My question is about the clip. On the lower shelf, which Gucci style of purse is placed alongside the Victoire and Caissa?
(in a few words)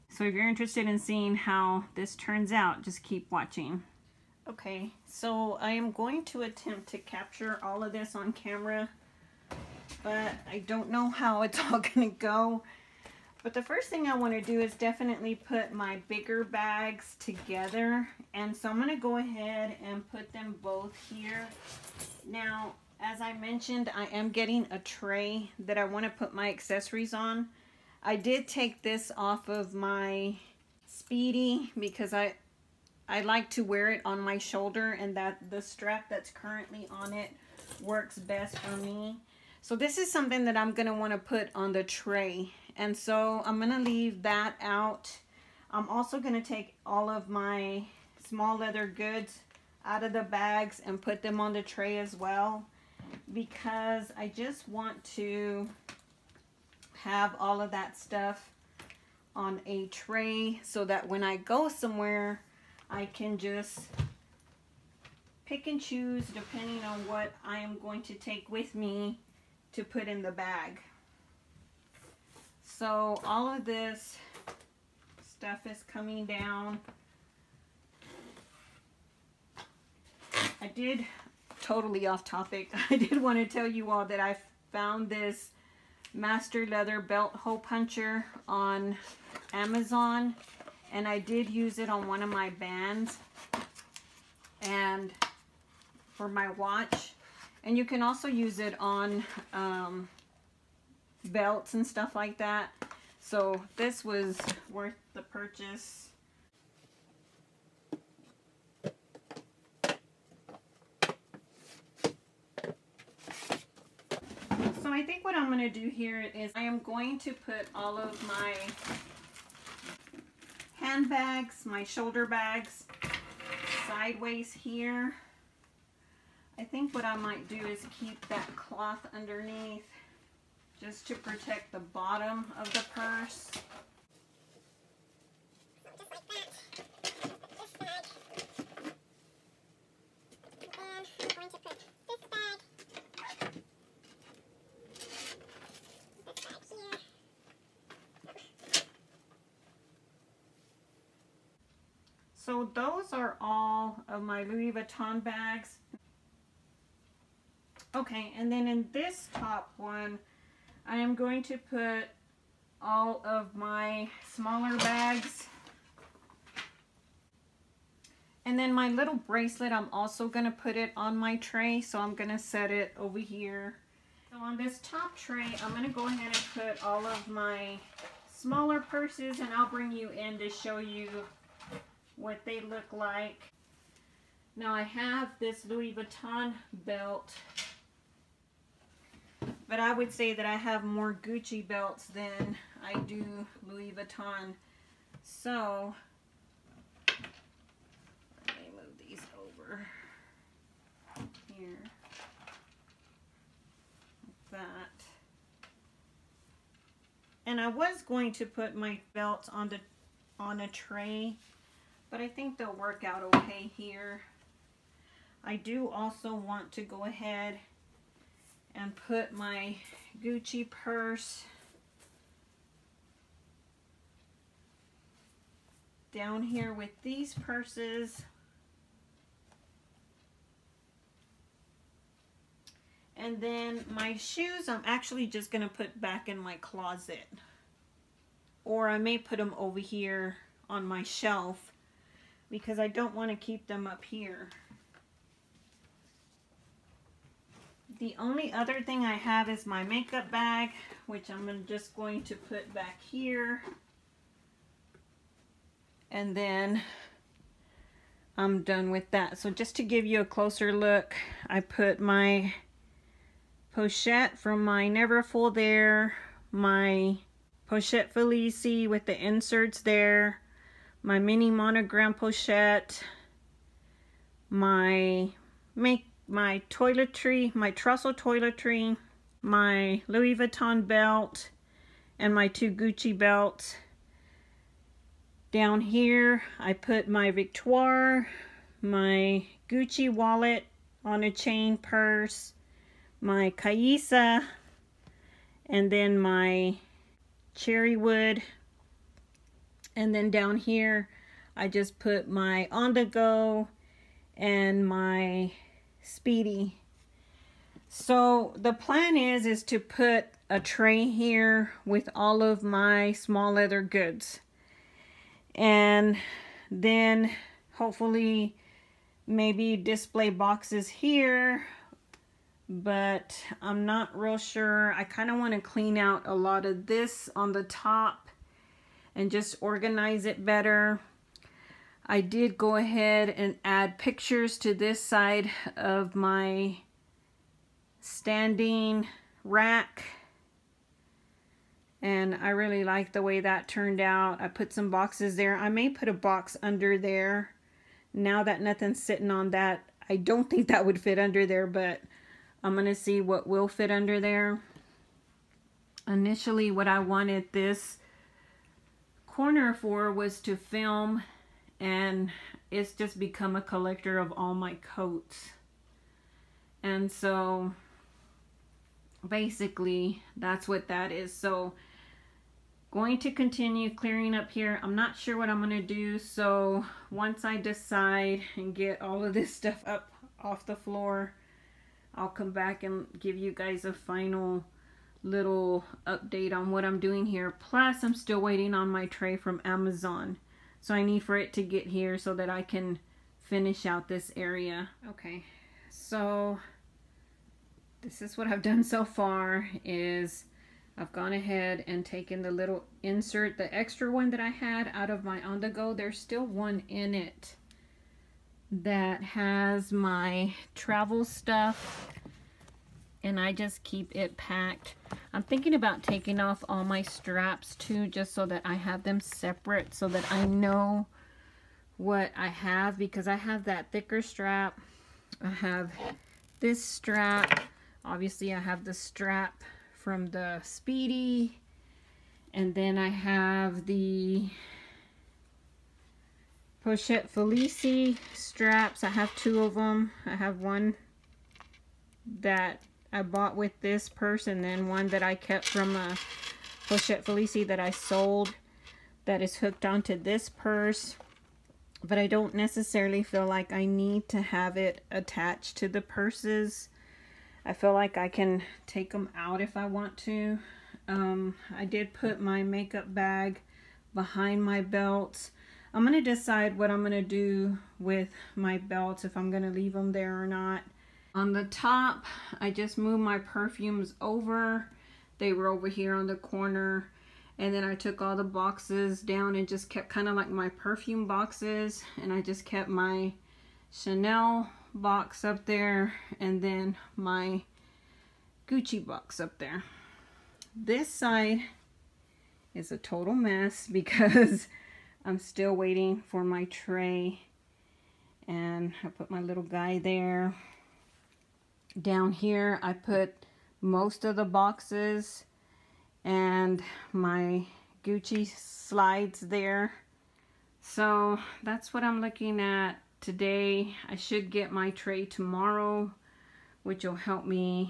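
wallet on a chain.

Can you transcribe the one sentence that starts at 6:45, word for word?
There's still one in it that has my travel stuff and I just keep it packed.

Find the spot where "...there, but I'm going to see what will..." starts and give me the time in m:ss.
5:51.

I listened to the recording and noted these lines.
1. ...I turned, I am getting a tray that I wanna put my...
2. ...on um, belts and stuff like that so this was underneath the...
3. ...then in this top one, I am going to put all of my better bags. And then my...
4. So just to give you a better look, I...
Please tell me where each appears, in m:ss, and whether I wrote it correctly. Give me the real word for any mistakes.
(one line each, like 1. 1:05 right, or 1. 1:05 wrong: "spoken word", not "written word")
1. 0:23 wrong: "mentioned", not "turned"
2. 1:38 wrong: "worth", not "underneath"
3. 2:38 wrong: "smaller", not "better"
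4. 4:19 wrong: "closer", not "better".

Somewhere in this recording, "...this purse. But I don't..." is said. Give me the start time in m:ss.
7:30.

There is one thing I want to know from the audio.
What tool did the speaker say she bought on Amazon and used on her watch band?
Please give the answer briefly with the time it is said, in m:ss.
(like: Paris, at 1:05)
master leather belt hole puncher, at 1:26.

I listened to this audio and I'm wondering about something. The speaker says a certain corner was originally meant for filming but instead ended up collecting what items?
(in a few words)
coats.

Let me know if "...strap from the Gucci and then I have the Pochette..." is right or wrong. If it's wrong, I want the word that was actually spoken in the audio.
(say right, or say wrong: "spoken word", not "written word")
wrong: "Speedy", not "Gucci".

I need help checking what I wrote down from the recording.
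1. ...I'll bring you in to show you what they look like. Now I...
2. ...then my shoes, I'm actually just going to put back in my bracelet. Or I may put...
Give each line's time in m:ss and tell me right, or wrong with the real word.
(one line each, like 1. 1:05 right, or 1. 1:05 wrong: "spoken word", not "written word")
1. 2:59 right
2. 3:53 wrong: "closet", not "bracelet".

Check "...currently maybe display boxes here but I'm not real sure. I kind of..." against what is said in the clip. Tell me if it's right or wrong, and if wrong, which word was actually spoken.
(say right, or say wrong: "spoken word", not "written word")
wrong: "hopefully", not "currently".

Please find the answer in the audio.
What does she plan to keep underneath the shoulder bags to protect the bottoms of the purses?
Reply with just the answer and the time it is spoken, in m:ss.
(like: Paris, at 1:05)
cloth, at 2:08.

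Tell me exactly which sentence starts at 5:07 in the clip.
So the plan is, is to put a tray here with all of my small leather goods.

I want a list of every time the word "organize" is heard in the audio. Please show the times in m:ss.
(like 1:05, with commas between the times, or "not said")
5:29.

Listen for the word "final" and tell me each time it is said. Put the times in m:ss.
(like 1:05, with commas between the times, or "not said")
6:23.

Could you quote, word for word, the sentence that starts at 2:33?
those are all of my Louis Vuitton bags.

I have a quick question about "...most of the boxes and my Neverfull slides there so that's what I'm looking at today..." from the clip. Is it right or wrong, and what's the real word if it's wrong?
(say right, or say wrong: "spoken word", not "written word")
wrong: "Gucci", not "Neverfull".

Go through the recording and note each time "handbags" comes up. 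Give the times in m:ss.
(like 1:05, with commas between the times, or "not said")
2:00.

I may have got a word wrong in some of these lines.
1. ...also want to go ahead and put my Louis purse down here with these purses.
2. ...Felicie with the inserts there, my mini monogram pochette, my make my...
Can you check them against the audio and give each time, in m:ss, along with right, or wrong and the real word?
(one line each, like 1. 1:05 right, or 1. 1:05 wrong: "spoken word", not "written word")
1. 3:35 wrong: "Gucci", not "Louis"
2. 4:28 right.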